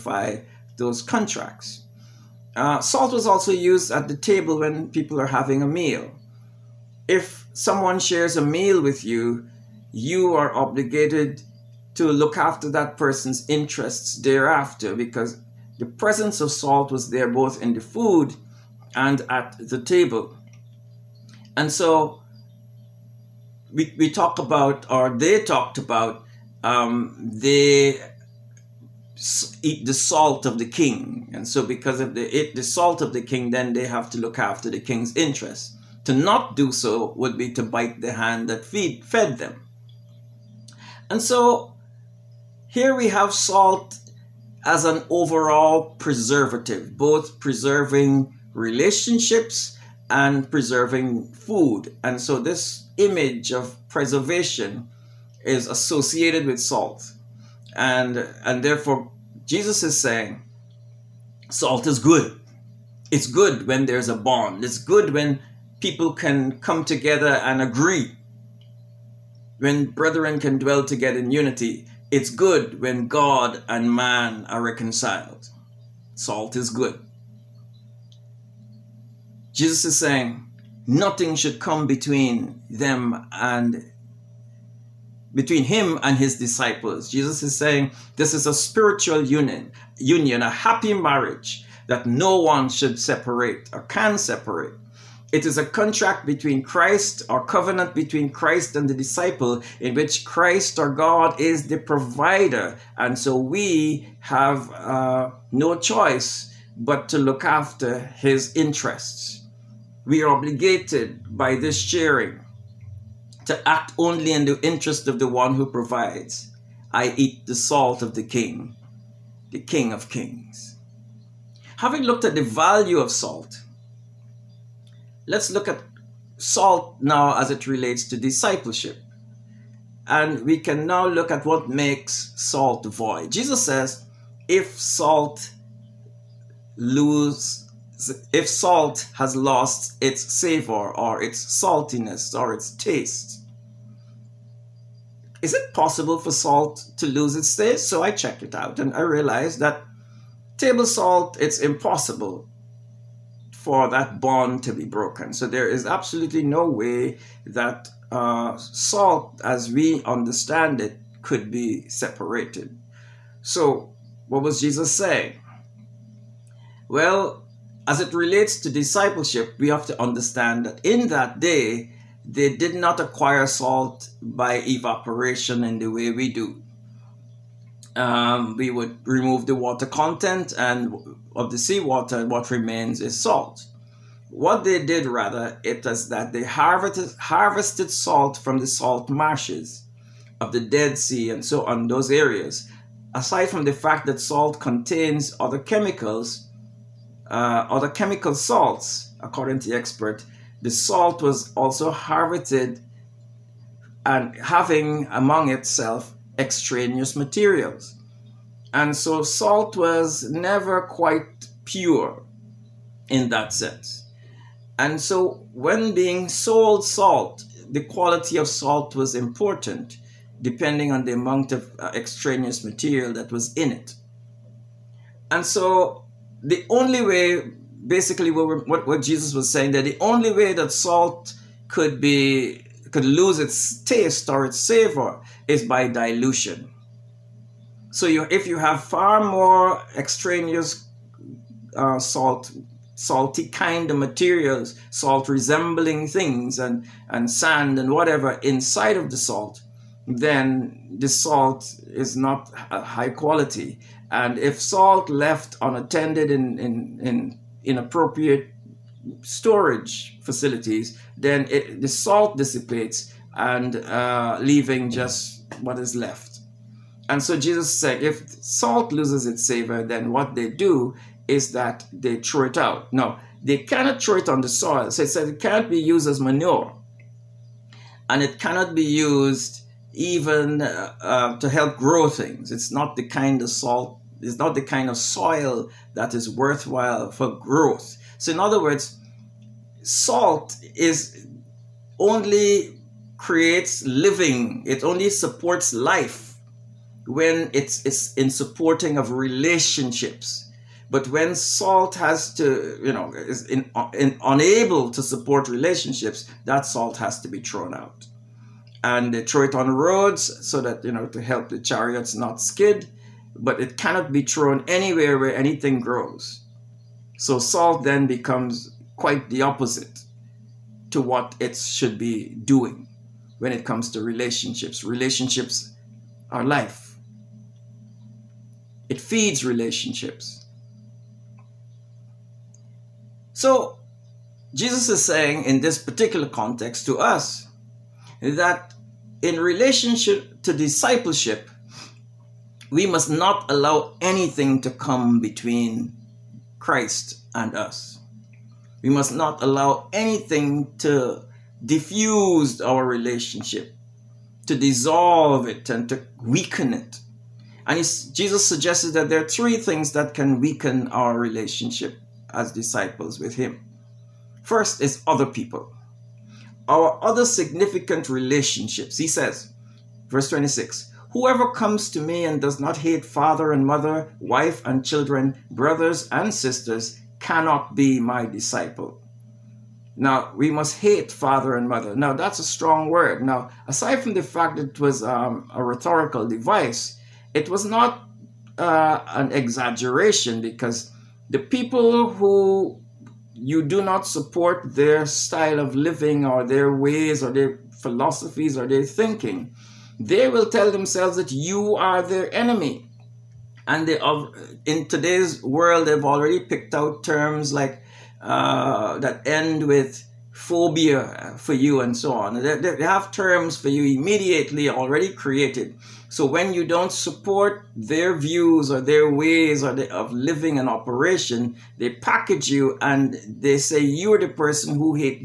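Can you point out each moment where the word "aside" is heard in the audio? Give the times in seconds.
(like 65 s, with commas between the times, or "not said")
193 s, 383 s.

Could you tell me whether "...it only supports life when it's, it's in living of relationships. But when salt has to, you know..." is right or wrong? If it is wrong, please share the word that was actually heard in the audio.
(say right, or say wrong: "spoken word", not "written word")
wrong: "supporting", not "living".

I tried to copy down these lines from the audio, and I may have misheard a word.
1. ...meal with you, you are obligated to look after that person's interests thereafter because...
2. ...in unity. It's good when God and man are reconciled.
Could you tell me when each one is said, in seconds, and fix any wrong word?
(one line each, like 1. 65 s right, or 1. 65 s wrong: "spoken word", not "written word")
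1. 8 s right
2. 71 s right.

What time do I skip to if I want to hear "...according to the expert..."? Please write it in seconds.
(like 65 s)
199 s.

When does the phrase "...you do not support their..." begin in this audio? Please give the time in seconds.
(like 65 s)
393 s.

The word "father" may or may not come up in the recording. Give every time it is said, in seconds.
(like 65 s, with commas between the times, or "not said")
373 s, 381 s.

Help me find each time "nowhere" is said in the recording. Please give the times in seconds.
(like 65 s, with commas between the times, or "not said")
not said.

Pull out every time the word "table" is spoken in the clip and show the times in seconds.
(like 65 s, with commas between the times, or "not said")
4 s, 19 s, 150 s.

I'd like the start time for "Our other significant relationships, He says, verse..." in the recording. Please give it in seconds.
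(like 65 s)
366 s.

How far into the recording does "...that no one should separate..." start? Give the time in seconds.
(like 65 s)
91 s.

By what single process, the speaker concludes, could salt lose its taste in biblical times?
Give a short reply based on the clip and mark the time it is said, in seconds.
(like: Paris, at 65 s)
Dilution, at 235 s.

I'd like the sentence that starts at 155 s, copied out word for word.
So there is absolutely no way that uh, salt, as we understand it, could be separated.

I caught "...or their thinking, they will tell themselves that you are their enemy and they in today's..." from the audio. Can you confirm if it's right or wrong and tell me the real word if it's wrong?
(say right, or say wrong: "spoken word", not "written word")
right.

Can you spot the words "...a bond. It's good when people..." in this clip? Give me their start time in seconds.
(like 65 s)
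64 s.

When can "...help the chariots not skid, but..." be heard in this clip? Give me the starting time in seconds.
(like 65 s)
311 s.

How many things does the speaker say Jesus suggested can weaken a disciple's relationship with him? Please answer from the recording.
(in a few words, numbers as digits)
3.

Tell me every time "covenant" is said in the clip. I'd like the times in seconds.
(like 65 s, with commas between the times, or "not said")
97 s.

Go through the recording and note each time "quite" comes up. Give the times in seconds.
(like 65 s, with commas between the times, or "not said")
210 s, 318 s.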